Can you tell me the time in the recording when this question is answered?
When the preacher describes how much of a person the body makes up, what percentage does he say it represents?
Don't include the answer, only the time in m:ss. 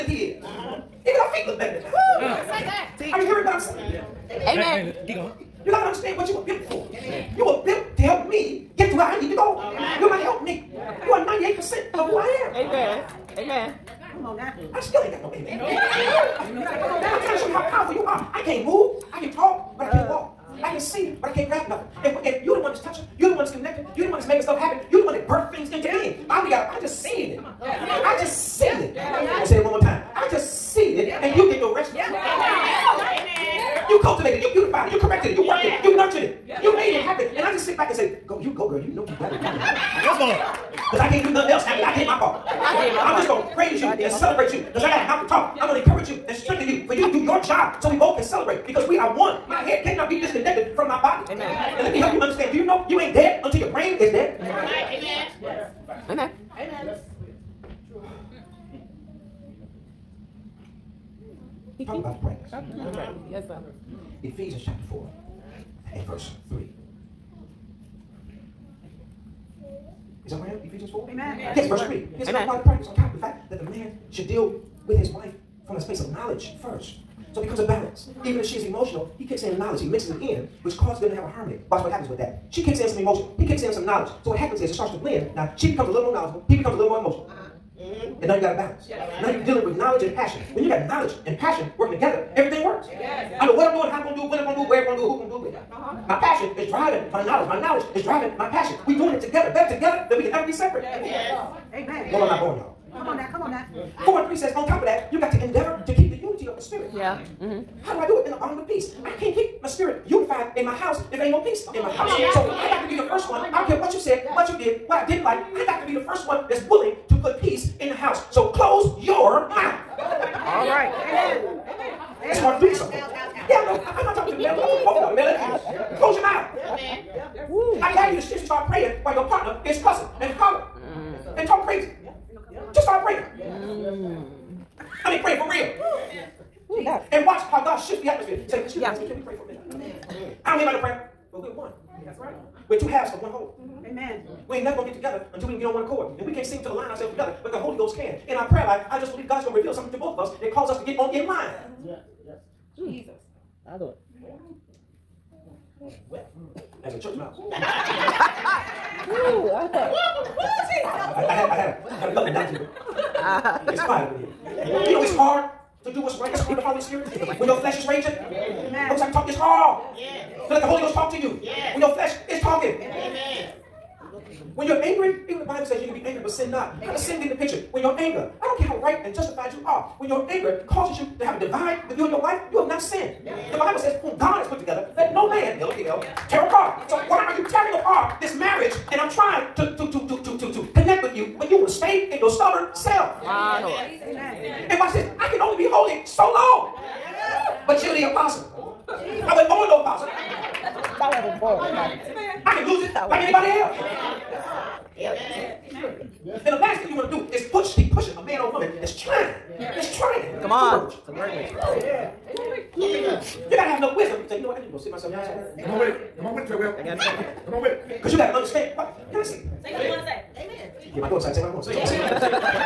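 0:11.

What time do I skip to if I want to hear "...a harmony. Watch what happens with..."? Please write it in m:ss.
1:21.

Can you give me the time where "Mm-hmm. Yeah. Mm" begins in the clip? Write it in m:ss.
2:31.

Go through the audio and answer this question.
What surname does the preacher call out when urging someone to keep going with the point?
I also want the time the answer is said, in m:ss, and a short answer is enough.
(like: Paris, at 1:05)
Treadwell, at 3:36.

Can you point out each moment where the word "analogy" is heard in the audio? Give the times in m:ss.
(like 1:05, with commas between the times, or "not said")
2:42.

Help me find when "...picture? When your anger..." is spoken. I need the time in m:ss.
2:57.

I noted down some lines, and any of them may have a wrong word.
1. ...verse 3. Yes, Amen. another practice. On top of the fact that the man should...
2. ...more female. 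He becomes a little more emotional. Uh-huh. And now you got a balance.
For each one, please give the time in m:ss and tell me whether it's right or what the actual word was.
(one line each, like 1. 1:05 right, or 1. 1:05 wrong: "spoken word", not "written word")
1. 1:11 right
2. 1:26 wrong: "knowledgeable", not "female".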